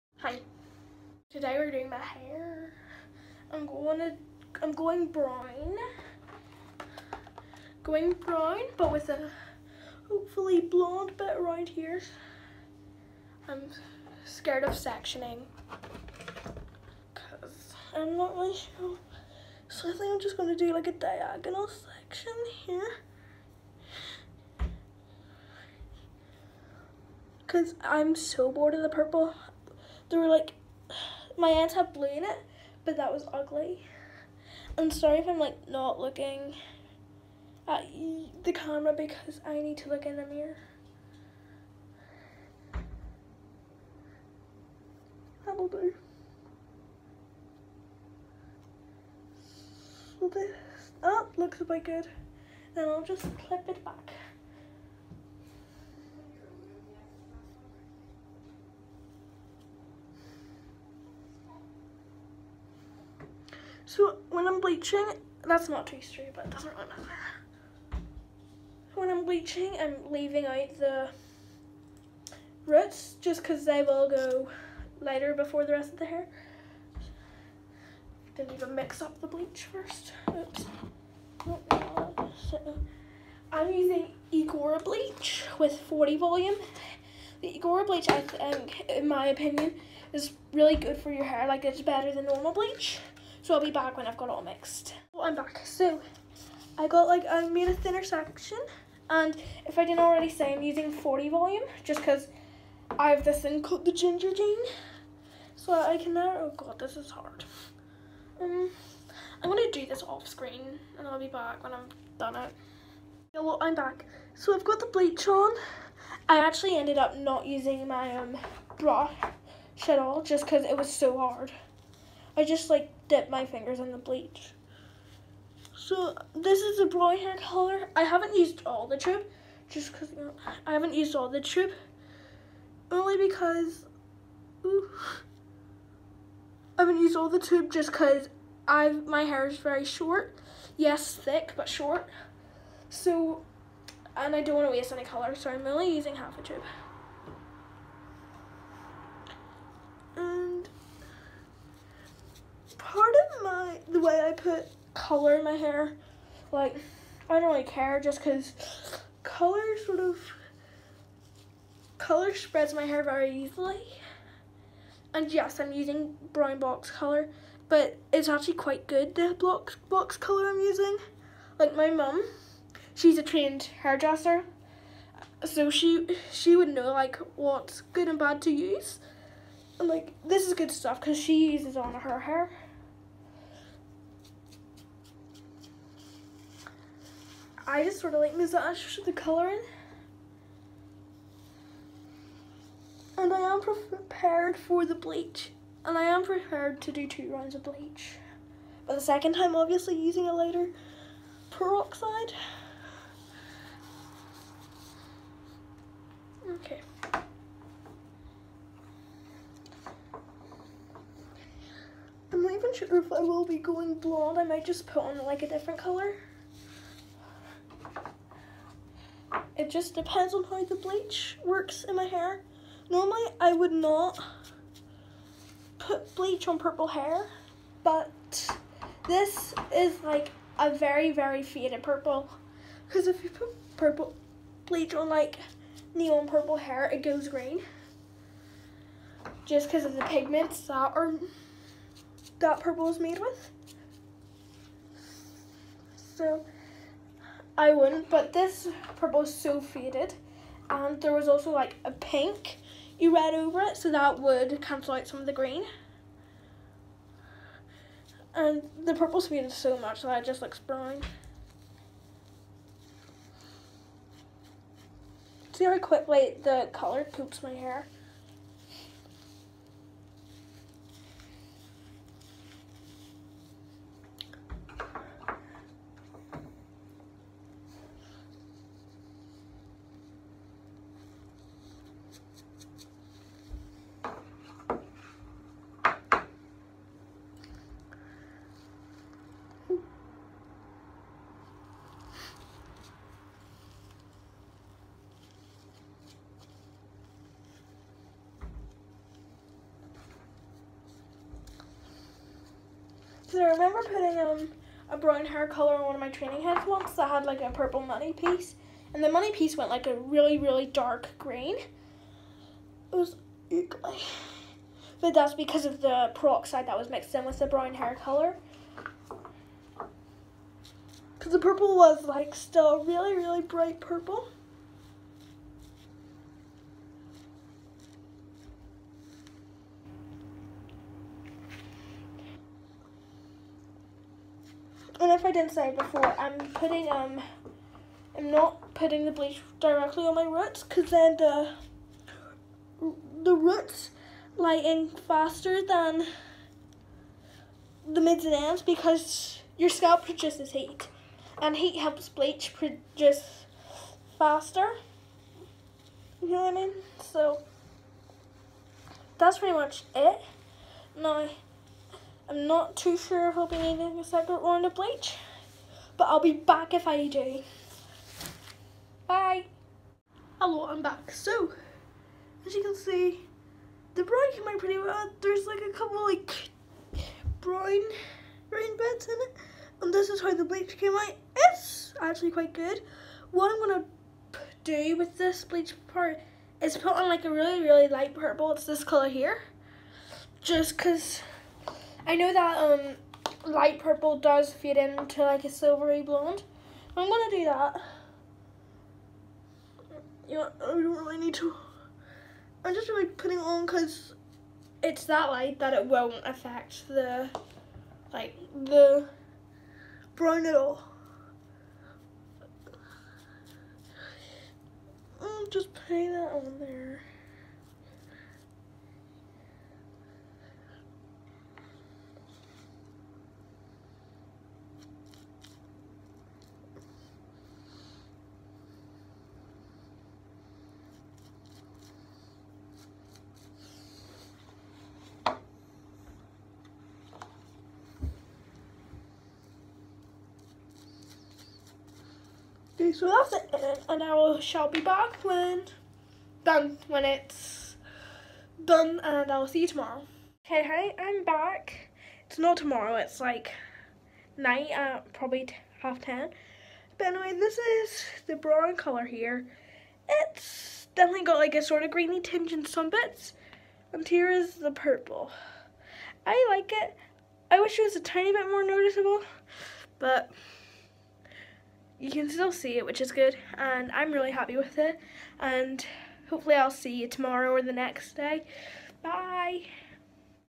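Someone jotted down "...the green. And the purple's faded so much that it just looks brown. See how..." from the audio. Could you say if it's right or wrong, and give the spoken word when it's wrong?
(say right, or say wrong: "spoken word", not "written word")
right.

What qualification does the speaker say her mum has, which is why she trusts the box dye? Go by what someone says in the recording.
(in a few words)
trained hairdresser.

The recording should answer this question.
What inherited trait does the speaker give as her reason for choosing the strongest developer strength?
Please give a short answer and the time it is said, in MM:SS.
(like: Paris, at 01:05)
The Ginger Gene, at 01:43.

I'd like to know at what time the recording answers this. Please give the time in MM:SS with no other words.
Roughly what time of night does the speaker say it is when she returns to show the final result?
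07:35.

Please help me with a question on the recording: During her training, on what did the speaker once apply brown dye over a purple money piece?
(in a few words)
training heads.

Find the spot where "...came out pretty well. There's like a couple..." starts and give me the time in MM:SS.
06:14.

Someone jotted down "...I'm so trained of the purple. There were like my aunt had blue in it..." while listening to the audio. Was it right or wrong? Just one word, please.
wrong.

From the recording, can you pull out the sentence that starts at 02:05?
So this is a brown hair color.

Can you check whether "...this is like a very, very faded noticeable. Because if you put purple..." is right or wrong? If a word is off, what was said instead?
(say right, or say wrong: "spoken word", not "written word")
wrong: "purple", not "noticeable".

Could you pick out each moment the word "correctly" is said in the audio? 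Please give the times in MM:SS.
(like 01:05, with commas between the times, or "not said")
not said.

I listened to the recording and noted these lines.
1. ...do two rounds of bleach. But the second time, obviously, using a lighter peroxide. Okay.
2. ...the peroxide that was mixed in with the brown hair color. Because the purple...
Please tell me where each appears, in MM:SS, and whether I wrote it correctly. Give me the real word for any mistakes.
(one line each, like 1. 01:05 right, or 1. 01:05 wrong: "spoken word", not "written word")
1. 03:16 right
2. 05:15 right.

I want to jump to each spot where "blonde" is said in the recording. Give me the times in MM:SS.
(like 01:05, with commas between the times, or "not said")
00:10, 03:33, 06:36.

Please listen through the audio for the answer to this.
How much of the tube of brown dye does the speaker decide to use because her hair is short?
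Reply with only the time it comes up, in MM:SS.
02:26.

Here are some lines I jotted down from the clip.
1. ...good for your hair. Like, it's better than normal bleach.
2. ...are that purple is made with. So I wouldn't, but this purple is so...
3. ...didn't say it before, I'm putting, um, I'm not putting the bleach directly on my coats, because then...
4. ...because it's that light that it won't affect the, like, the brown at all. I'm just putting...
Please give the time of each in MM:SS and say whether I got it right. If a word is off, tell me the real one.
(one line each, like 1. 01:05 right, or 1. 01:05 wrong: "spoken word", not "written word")
1. 01:30 right
2. 04:00 right
3. 05:35 wrong: "roots", not "coats"
4. 06:43 right.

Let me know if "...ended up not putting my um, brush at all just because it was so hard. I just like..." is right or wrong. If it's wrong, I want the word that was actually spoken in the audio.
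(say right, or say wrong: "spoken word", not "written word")
wrong: "using", not "putting".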